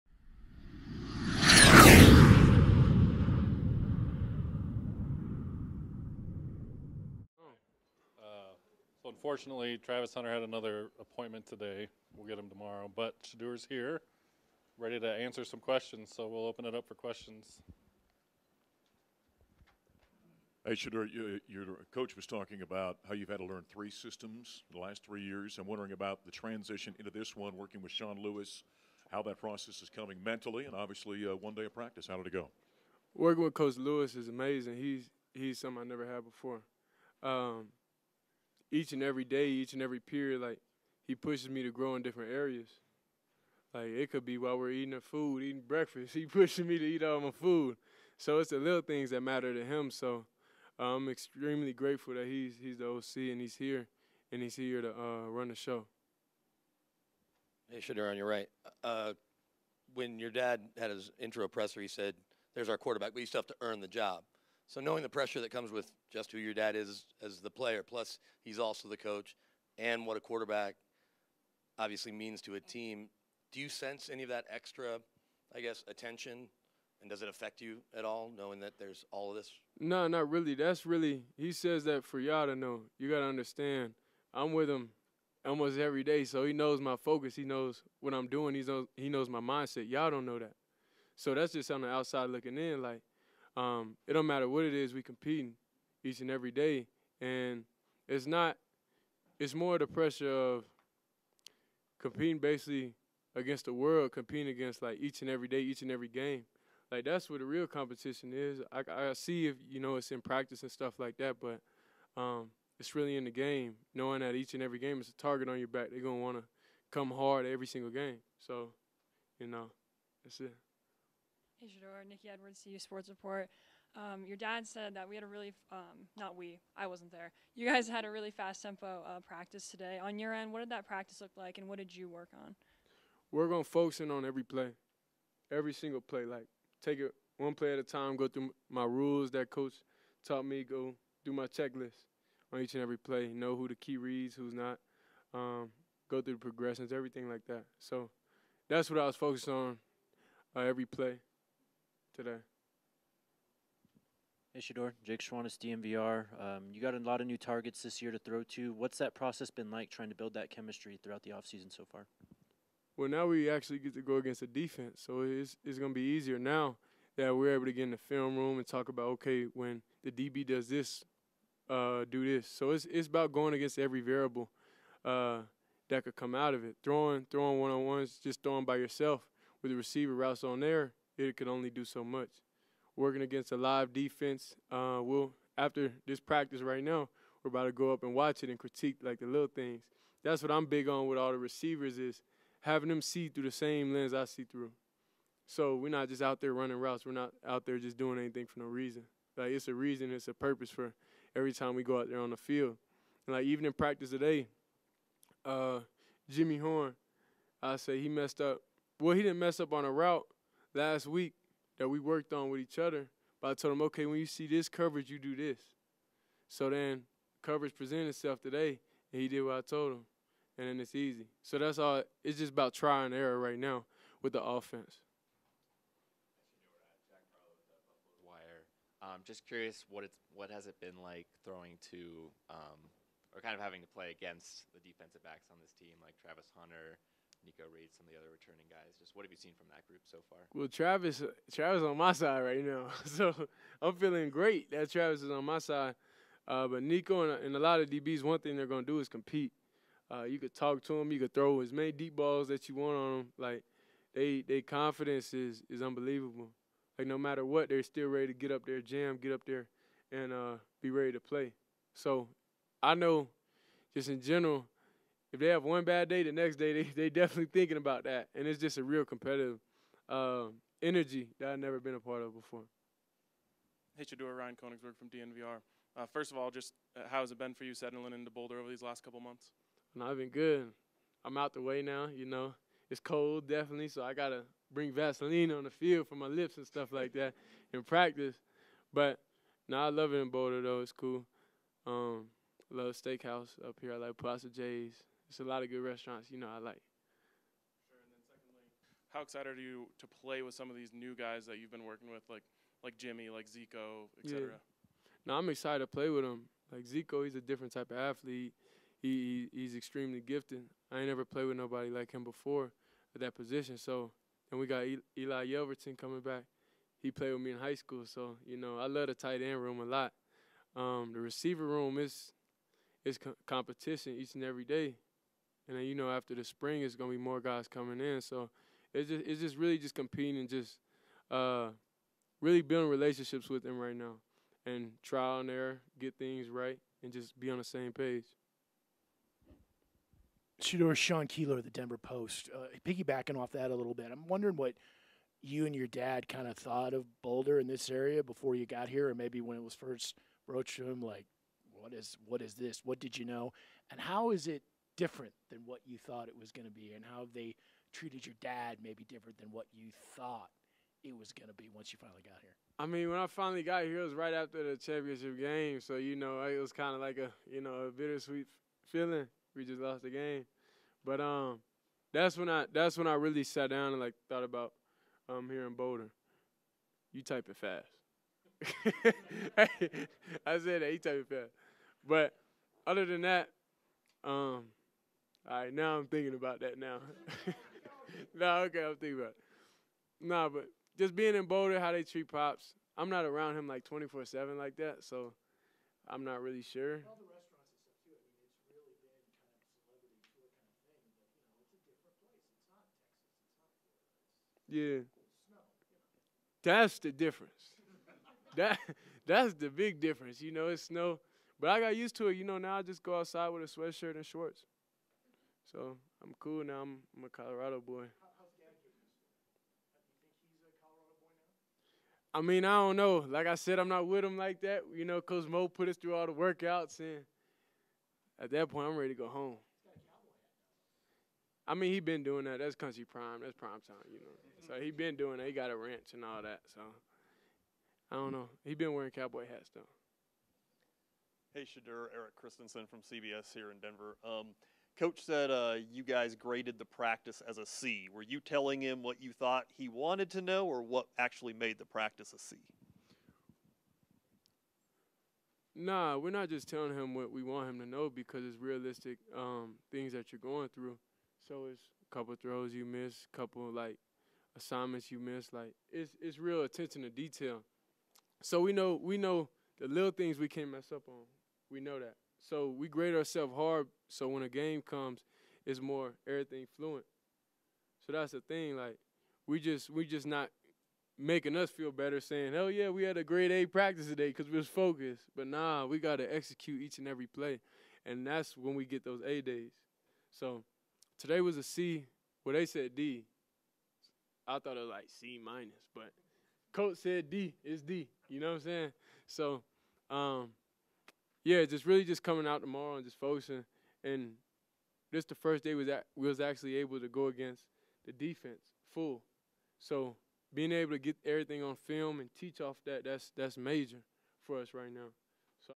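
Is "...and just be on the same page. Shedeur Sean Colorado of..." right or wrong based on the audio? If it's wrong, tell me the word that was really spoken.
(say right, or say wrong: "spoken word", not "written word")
wrong: "Keeler", not "Colorado".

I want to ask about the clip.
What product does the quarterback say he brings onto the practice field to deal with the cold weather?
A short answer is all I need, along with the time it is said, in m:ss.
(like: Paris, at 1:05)
Vaseline, at 4:44.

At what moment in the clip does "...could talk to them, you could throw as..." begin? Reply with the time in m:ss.
4:10.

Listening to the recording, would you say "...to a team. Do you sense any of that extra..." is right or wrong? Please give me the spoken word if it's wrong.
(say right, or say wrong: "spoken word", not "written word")
right.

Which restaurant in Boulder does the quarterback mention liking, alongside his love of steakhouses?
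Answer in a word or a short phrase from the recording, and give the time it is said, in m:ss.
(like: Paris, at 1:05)
Plaza J's, at 4:54.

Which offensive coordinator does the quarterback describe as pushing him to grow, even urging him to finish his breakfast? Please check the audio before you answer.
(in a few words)
Sean Lewis.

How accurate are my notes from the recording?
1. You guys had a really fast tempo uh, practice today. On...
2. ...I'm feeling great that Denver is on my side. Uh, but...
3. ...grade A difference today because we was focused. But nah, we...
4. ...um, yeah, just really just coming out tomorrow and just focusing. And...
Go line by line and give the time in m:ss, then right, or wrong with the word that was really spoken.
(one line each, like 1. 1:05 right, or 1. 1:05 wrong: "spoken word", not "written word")
1. 2:07 right
2. 4:03 wrong: "Travis", not "Denver"
3. 8:03 wrong: "practice", not "difference"
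4. 8:20 right.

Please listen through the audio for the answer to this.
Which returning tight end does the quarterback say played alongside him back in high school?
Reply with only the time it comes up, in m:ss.
5:15.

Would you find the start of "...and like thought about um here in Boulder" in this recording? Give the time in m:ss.
6:13.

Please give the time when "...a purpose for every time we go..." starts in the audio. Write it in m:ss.
3:20.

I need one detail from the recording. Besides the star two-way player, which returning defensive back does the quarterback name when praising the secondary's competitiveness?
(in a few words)
Nikko Reed.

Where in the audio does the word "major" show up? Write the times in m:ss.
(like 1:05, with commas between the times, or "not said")
8:33.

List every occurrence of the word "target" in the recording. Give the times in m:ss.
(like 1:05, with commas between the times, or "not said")
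1:55, 2:37.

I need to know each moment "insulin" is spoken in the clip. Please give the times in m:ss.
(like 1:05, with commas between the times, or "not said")
not said.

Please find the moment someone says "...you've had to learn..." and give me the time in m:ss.
0:23.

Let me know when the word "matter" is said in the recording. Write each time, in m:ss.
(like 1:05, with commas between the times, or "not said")
0:49, 1:34, 4:17.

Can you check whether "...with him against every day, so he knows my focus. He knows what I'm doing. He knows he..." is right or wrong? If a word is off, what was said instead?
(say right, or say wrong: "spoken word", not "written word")
wrong: "almost", not "against".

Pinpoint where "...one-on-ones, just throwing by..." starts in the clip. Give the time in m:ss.
2:57.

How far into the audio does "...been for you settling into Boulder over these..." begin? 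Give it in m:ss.
4:37.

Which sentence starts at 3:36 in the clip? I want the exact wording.
So then coverage presented itself today, and he did what I told him.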